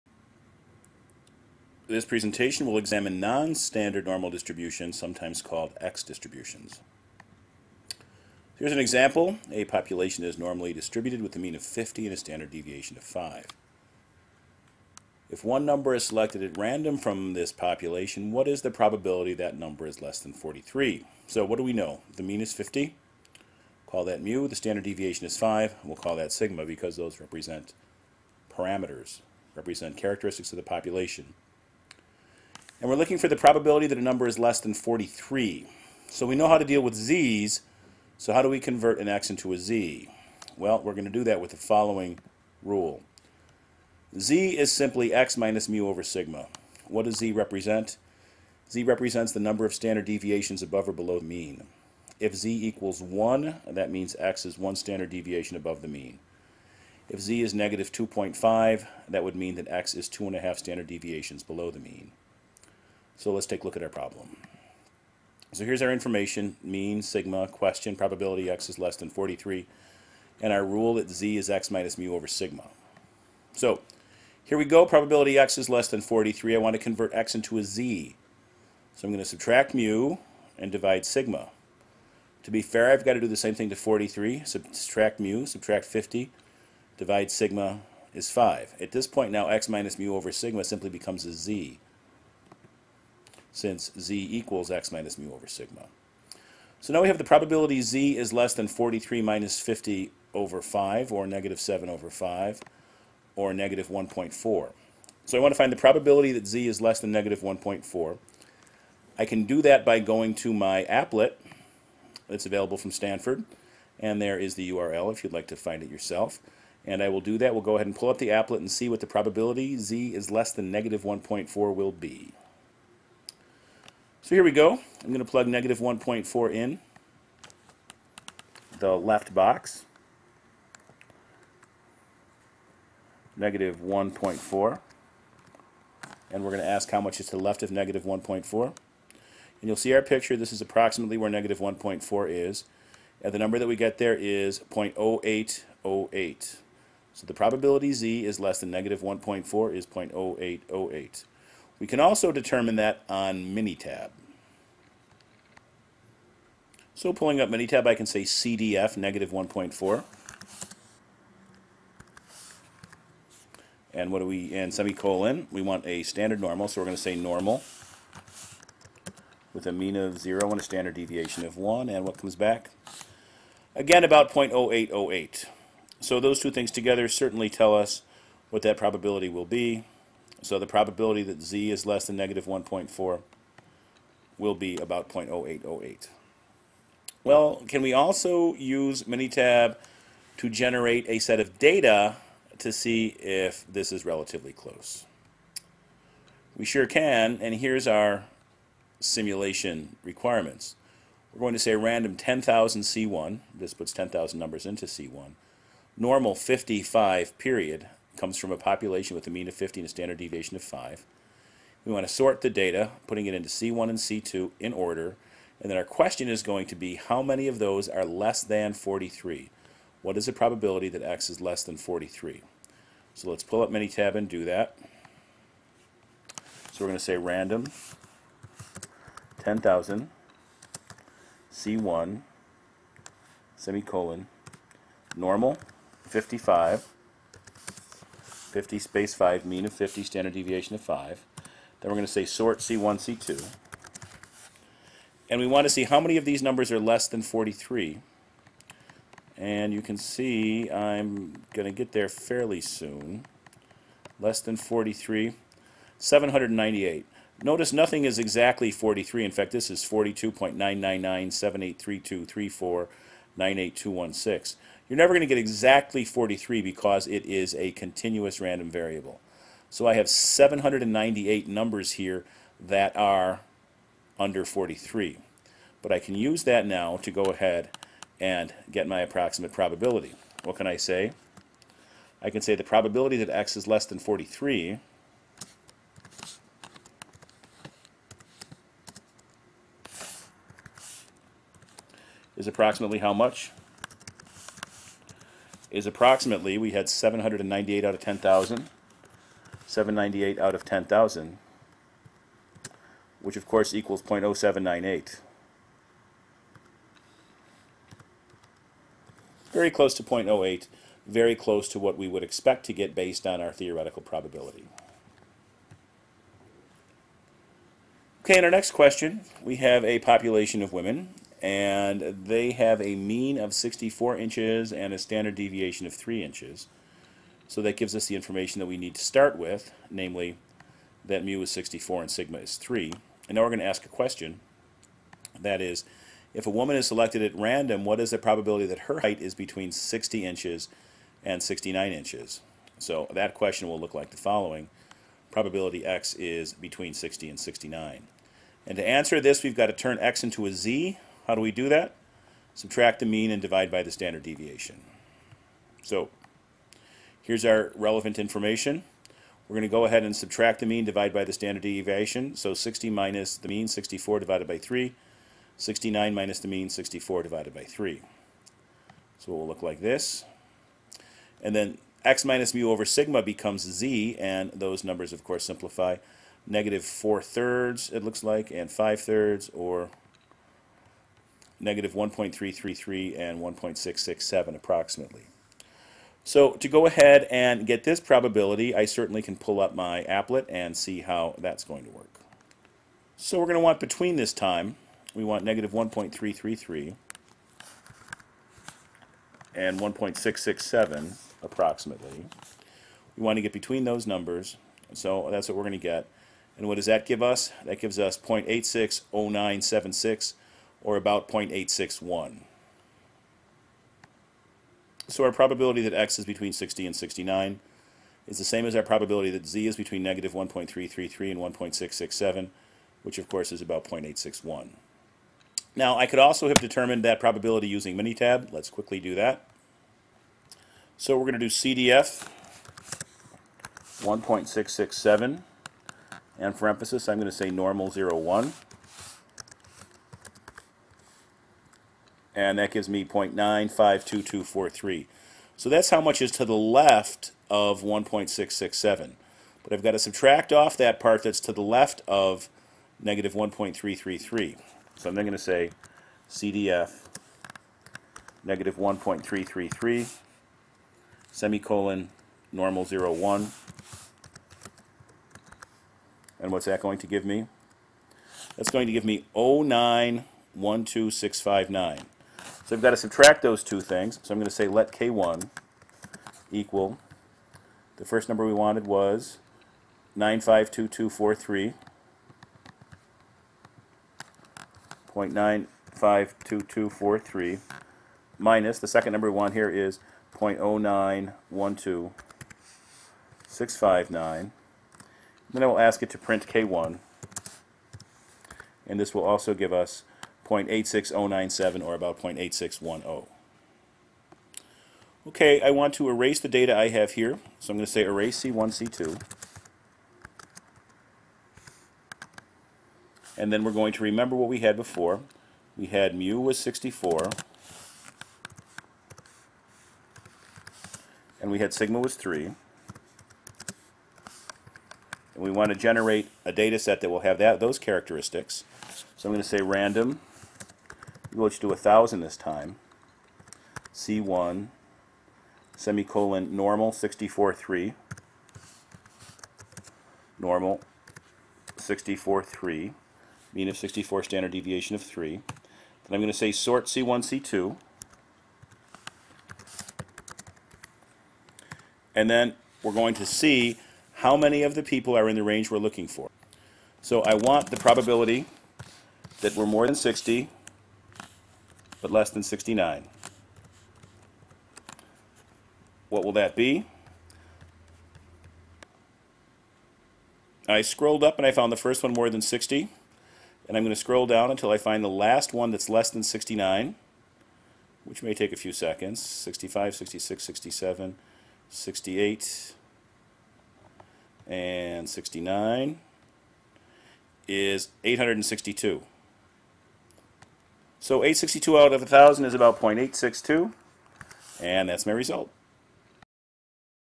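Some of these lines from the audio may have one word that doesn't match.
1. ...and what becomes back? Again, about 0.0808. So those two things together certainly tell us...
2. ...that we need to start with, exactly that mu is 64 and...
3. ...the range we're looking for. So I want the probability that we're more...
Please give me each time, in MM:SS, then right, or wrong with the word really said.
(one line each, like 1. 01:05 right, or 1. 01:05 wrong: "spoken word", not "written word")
1. 02:51 wrong: "comes", not "becomes"
2. 05:28 wrong: "namely", not "exactly"
3. 09:15 right.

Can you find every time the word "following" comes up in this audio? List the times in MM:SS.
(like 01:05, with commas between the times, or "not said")
00:41, 05:44.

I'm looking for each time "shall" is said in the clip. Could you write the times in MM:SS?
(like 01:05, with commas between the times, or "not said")
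not said.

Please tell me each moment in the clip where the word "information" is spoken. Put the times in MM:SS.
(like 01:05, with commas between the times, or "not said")
01:05, 05:28, 05:58.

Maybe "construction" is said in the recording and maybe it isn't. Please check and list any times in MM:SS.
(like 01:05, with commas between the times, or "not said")
not said.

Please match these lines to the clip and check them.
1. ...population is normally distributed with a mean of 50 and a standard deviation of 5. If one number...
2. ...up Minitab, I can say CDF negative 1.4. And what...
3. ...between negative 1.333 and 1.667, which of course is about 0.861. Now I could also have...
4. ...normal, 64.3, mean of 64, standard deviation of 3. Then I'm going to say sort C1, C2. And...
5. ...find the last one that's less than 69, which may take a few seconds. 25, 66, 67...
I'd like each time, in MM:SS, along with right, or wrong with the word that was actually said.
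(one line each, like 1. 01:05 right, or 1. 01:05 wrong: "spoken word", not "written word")
1. 00:09 right
2. 02:37 right
3. 06:59 right
4. 09:00 right
5. 09:34 wrong: "65", not "25".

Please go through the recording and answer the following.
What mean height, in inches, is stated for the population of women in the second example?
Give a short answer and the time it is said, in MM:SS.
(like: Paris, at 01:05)
64 inches, at 05:22.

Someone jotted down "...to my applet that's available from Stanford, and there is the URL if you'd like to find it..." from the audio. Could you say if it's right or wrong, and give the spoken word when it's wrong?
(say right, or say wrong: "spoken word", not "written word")
right.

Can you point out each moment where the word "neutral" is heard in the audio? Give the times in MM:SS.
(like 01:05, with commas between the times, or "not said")
not said.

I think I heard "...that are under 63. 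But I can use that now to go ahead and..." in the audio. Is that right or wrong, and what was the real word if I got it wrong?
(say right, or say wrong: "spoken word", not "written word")
wrong: "43", not "63".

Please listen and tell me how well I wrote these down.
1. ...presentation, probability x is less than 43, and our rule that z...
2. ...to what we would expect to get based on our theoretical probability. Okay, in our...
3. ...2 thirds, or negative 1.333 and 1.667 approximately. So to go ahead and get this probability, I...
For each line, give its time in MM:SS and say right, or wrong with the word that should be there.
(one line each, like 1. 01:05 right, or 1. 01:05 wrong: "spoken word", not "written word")
1. 01:07 wrong: "question", not "presentation"
2. 05:11 right
3. 06:18 wrong: "5", not "2".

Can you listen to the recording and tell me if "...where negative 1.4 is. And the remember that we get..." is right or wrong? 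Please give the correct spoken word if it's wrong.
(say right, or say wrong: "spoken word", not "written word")
wrong: "number", not "remember".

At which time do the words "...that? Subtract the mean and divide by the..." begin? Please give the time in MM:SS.
05:51.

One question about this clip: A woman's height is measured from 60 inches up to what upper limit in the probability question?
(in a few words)
69 inches.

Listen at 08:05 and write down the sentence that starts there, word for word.
0.952243 minus the second number we want here is 0.0912659.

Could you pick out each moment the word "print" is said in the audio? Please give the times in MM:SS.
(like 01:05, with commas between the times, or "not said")
08:16.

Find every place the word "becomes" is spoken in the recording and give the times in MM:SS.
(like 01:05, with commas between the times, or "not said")
01:30, 06:13.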